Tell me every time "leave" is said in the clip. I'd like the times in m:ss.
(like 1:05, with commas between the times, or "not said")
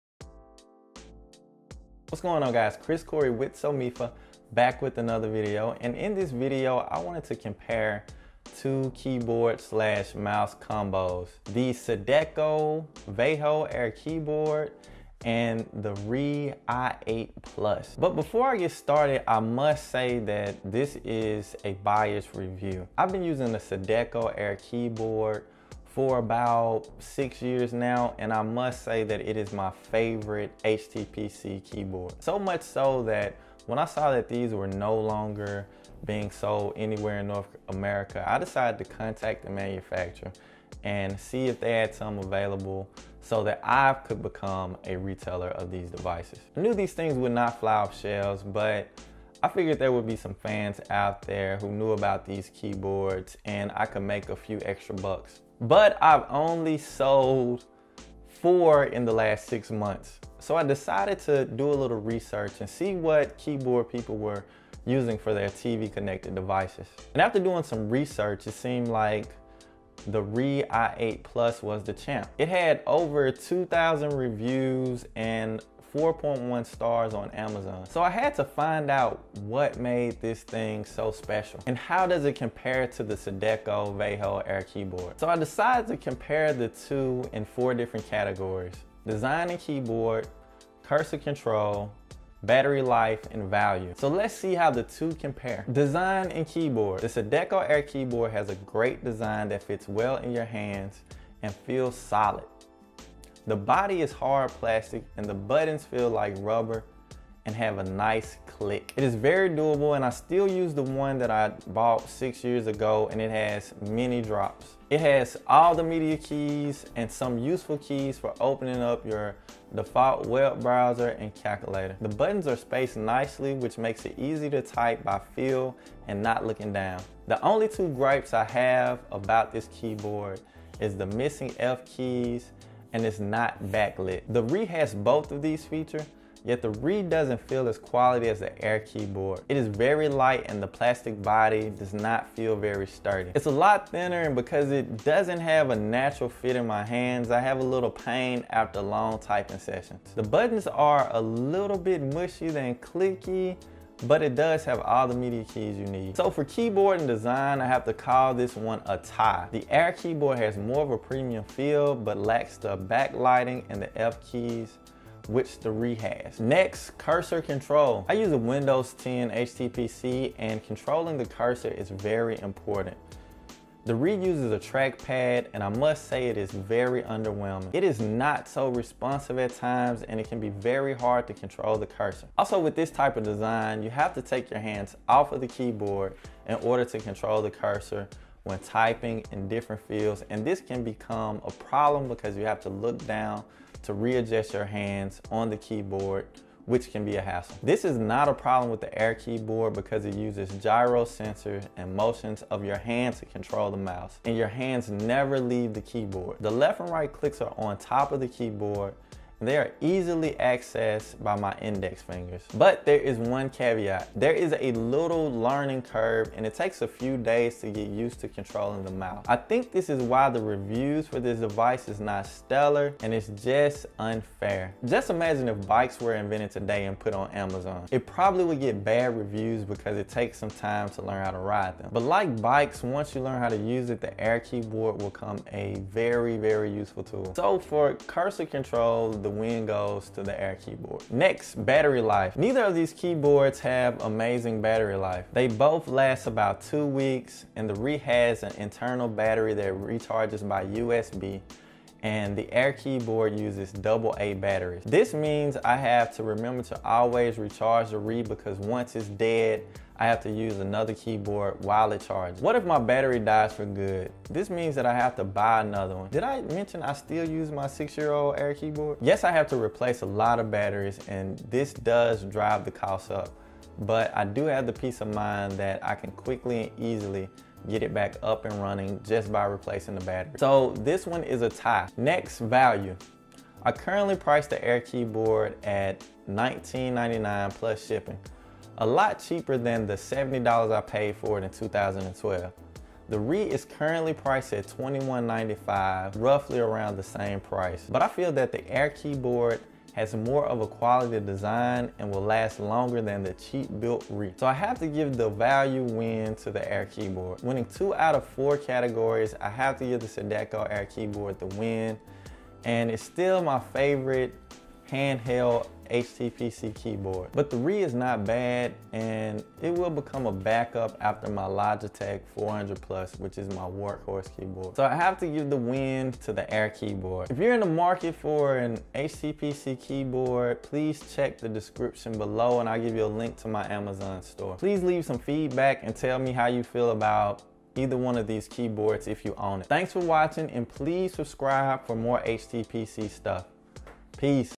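3:25, 5:34.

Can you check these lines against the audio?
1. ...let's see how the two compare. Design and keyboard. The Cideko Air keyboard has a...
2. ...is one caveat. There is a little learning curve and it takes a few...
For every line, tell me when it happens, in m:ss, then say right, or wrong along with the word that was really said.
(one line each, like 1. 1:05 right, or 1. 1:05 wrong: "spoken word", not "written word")
1. 1:34 right
2. 3:32 right.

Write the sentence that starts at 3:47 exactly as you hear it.
It probably would get bad reviews because it takes some time to learn how to ride them.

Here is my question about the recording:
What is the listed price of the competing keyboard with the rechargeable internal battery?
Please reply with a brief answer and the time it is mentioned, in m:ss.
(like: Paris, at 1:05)
$21.95, at 4:54.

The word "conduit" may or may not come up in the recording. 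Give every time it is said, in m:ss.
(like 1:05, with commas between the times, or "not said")
not said.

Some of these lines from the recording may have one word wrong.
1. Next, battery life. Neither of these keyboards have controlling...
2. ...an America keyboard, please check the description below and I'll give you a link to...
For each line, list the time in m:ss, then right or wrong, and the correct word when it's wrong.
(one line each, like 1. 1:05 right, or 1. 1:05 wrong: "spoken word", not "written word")
1. 4:01 wrong: "amazing", not "controlling"
2. 5:28 wrong: "HTPC", not "America".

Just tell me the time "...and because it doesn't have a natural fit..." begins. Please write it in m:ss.
2:24.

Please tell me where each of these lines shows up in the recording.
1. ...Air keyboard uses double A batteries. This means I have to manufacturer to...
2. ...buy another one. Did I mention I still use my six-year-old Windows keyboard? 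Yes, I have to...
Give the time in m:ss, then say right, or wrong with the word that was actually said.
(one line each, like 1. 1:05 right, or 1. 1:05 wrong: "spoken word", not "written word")
1. 4:12 wrong: "remember", not "manufacturer"
2. 4:25 wrong: "Air", not "Windows".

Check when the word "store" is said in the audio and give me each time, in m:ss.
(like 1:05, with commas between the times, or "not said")
5:34.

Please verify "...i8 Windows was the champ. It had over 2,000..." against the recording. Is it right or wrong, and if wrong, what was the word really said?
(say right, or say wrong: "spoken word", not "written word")
wrong: "Plus", not "Windows".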